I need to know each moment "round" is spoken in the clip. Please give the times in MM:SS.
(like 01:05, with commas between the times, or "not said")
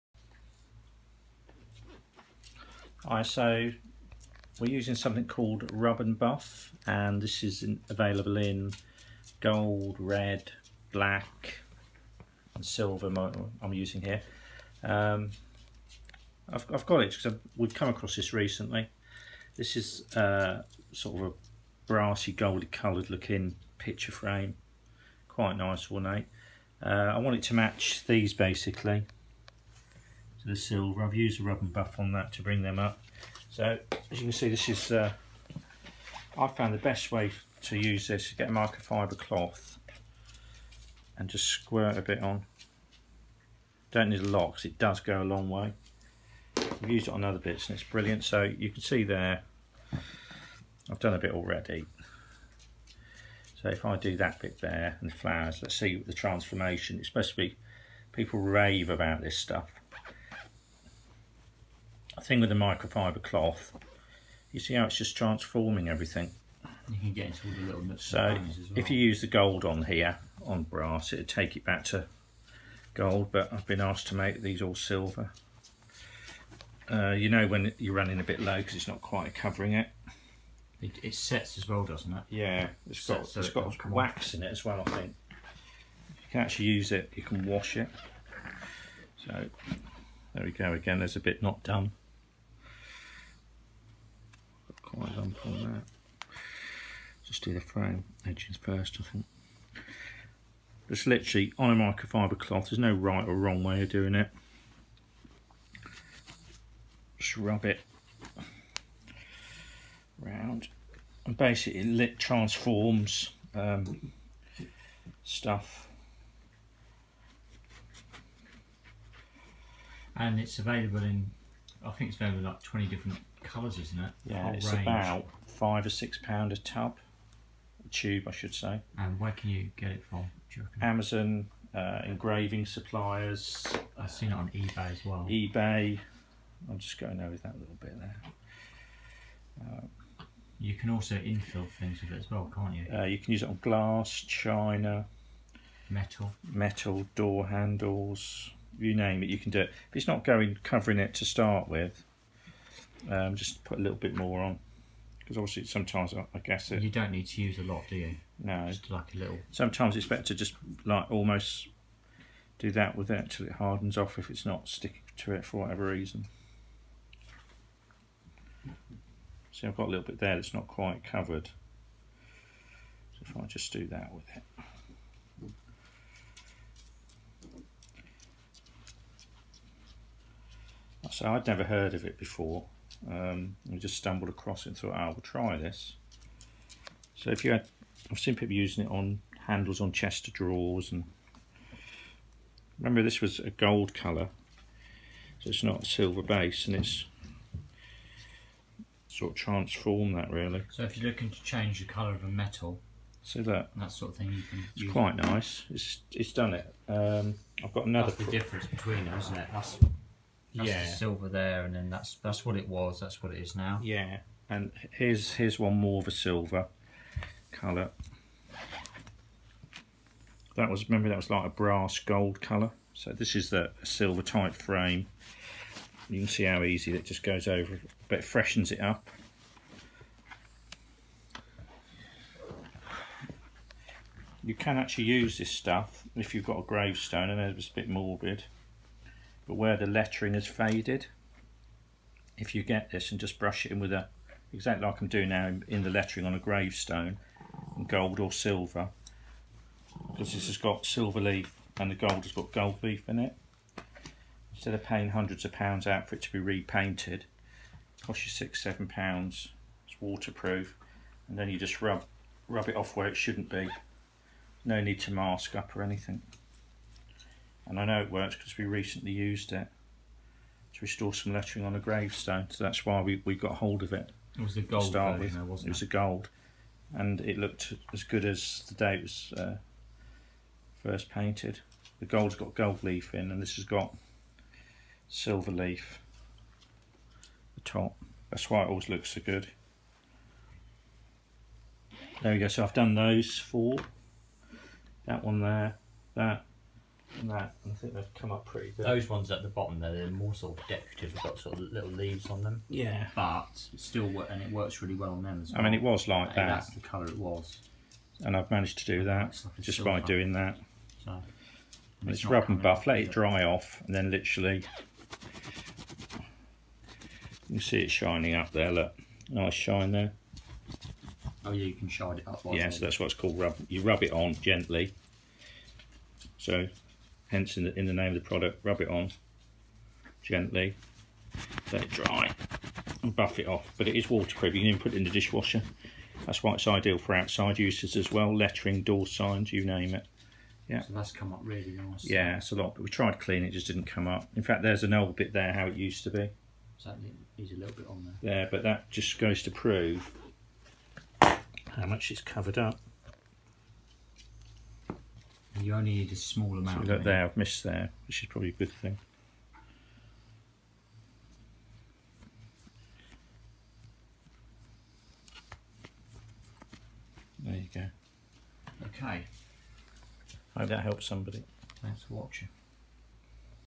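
01:50.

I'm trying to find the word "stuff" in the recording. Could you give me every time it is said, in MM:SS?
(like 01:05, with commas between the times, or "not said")
00:59, 01:55, 03:55.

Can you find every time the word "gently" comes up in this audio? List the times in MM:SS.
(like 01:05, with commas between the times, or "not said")
05:24, 05:30.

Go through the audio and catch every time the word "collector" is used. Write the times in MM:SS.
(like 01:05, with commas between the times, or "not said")
not said.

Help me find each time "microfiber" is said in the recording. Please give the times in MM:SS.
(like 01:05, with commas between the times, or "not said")
00:38, 01:02, 01:41.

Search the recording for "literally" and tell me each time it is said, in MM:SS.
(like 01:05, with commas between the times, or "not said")
01:41, 05:14.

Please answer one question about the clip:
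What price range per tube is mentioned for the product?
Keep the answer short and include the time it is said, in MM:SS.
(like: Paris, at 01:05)
five or six pound, at 02:04.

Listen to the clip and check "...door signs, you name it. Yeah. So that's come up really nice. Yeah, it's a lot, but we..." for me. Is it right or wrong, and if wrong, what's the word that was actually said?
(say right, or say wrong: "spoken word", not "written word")
right.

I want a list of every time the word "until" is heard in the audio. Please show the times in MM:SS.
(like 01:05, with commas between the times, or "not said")
02:43.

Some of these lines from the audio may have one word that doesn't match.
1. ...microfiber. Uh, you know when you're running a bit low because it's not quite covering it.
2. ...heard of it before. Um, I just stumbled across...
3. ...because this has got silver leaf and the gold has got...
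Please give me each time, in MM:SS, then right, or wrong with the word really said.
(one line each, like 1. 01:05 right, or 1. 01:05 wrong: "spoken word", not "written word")
1. 01:14 wrong: "silver", not "microfiber"
2. 03:01 right
3. 04:10 right.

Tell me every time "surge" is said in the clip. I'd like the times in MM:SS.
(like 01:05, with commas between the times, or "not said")
not said.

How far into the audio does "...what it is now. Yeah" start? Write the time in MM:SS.
03:33.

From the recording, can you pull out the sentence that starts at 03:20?
So if you're looking to change the colour of a metal, so that that sort of thing, you can.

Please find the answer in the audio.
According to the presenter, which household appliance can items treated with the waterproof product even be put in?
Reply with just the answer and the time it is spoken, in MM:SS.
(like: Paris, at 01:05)
Dishwasher, at 05:35.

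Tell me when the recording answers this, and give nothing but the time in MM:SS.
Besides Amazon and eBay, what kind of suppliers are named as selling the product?
02:12.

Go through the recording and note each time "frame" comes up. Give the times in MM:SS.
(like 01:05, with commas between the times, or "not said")
00:24, 01:37, 03:44.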